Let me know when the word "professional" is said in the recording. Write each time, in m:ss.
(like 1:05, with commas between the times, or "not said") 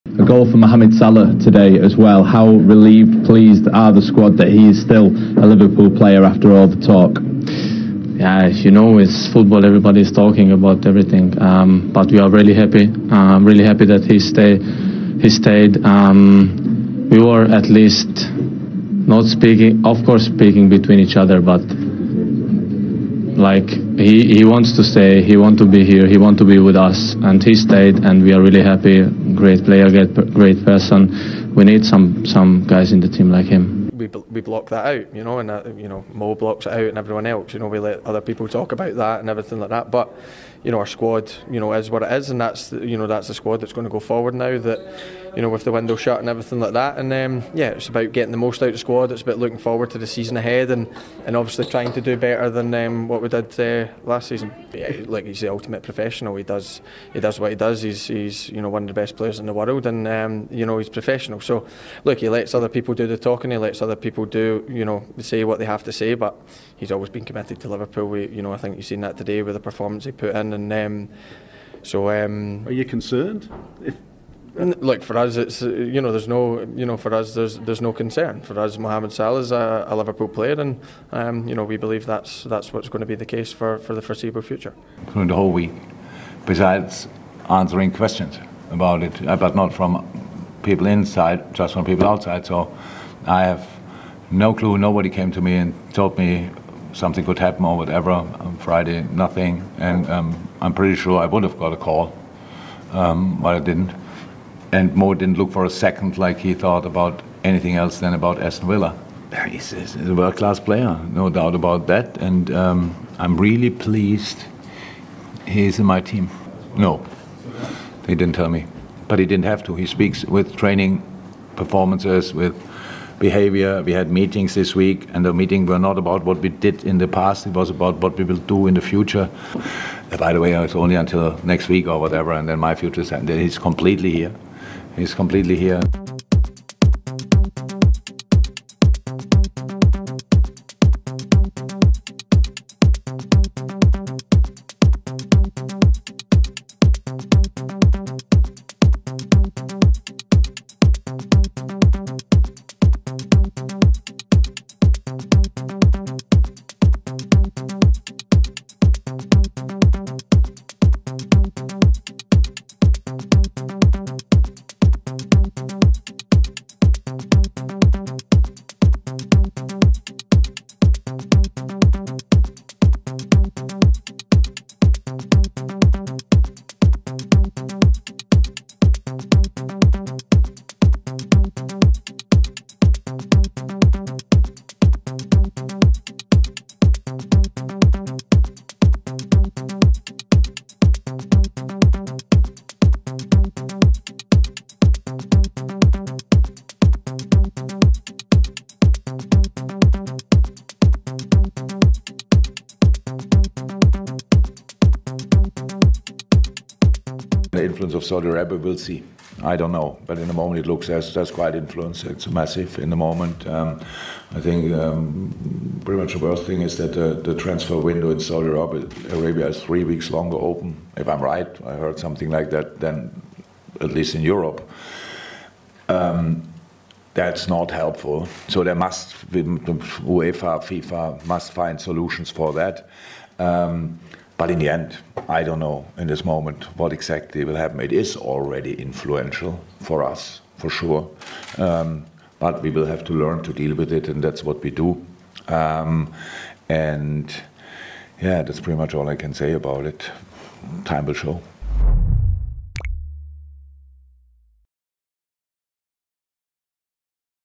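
0:55, 1:00.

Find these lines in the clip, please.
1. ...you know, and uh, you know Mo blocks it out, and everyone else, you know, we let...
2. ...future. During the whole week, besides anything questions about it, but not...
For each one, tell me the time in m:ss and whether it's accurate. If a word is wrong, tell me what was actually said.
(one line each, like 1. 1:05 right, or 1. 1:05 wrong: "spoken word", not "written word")
1. 0:35 right
2. 1:24 wrong: "answering", not "anything".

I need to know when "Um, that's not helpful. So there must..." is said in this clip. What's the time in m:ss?
3:45.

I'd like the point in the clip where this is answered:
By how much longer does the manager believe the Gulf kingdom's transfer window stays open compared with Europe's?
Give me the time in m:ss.
3:39.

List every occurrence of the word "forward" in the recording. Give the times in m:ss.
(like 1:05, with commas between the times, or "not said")
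0:43, 0:49.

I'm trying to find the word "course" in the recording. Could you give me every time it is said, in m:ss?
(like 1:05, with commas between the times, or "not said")
0:20.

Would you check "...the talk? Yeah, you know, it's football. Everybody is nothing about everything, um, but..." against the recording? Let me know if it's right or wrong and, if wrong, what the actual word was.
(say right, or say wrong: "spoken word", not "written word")
wrong: "talking", not "nothing".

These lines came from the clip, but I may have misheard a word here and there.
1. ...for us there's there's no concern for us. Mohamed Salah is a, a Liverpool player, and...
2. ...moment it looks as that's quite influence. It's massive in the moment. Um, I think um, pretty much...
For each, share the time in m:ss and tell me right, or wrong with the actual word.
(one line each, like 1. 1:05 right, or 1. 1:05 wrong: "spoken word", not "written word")
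1. 1:16 right
2. 3:30 right.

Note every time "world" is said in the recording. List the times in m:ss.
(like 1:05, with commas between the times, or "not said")
0:59, 1:50.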